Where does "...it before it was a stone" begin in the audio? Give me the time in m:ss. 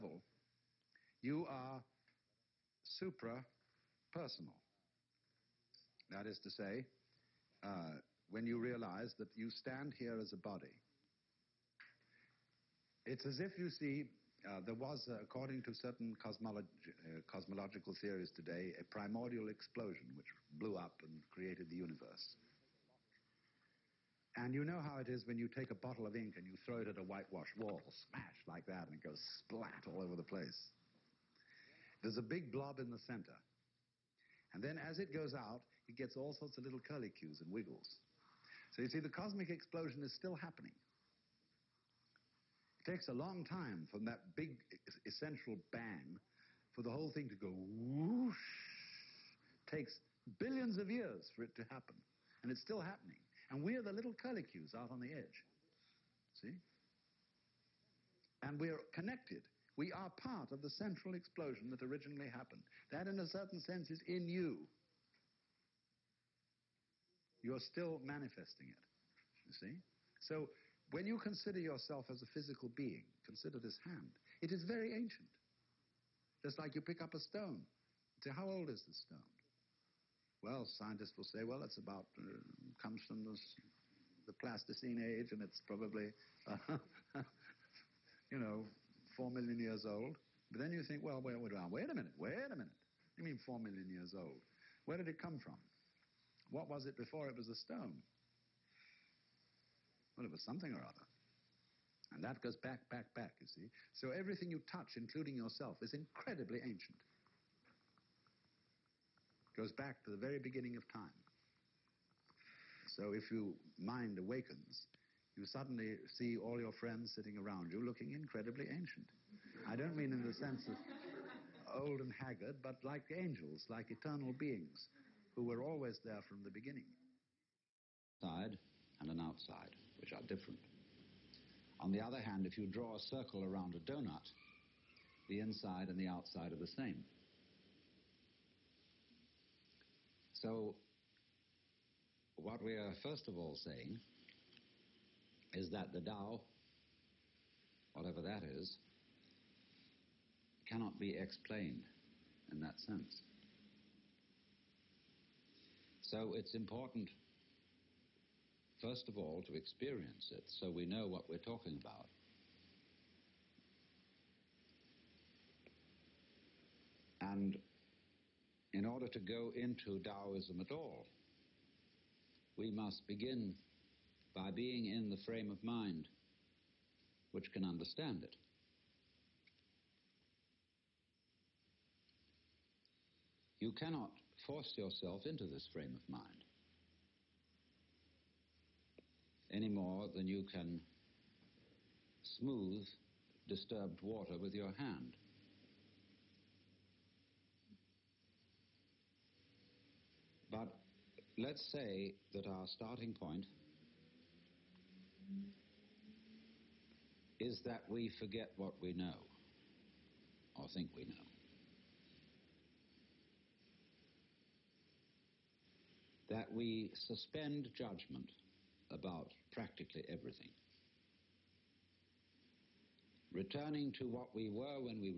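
1:36.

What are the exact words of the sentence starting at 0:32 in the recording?
There's a big blob in the center.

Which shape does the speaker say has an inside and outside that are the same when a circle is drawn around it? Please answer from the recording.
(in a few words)
a donut.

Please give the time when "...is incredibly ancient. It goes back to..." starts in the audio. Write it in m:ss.
1:45.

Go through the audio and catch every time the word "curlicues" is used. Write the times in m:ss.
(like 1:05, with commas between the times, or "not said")
0:36, 0:54.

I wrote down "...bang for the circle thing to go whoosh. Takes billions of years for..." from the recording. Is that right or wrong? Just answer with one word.
wrong.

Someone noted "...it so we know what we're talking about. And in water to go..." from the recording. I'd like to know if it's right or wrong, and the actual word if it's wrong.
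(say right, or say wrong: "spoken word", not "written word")
wrong: "order", not "water".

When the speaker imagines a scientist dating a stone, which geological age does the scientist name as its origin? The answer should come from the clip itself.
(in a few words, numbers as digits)
Pleistocene.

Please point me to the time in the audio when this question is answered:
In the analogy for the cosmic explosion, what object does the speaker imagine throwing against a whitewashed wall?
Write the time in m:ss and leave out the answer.
0:25.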